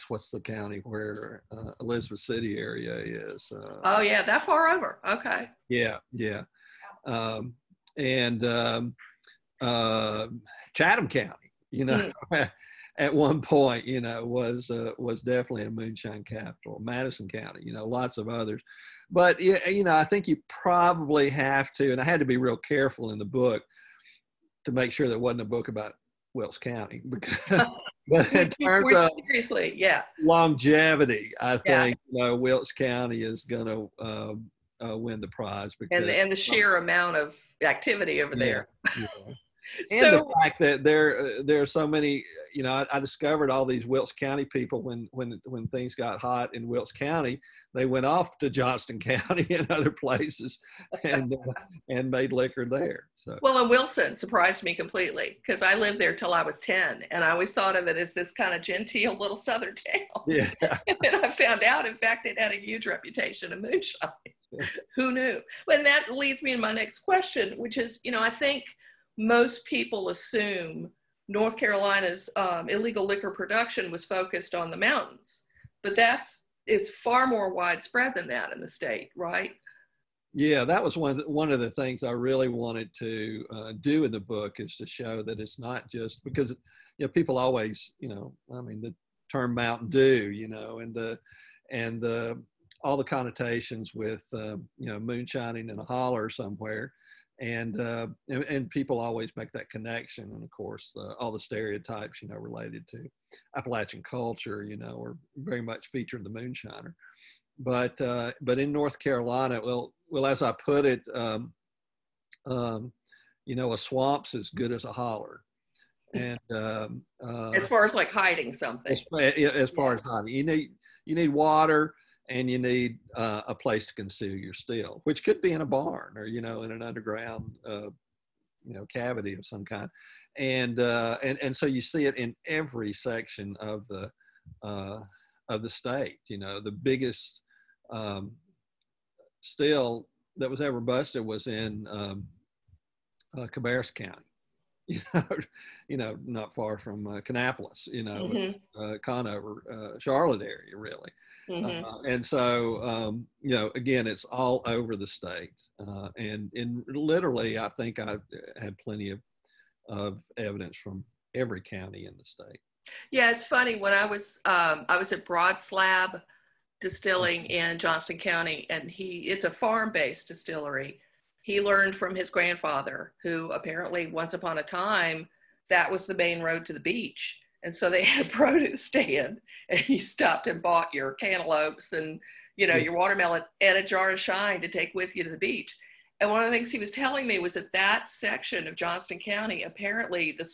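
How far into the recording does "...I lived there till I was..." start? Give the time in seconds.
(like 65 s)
55 s.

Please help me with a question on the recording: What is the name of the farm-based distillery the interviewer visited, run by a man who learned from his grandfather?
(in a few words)
Broad Slab Distilling.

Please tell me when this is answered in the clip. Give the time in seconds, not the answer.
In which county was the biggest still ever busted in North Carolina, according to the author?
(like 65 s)
143 s.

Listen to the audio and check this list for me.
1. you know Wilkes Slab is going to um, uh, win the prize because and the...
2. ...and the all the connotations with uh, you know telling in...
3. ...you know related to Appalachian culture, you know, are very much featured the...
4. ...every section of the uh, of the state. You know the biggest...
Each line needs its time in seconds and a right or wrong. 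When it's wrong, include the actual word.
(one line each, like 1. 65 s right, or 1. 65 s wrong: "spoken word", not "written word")
1. 31 s wrong: "County", not "Slab"
2. 91 s wrong: "moonshining", not "telling"
3. 102 s right
4. 132 s right.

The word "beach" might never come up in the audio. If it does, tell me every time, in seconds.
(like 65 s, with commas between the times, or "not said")
176 s, 185 s.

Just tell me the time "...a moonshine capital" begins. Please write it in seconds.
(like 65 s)
15 s.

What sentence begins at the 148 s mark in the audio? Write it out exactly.
uh, Conover, uh, Charlotte area, really.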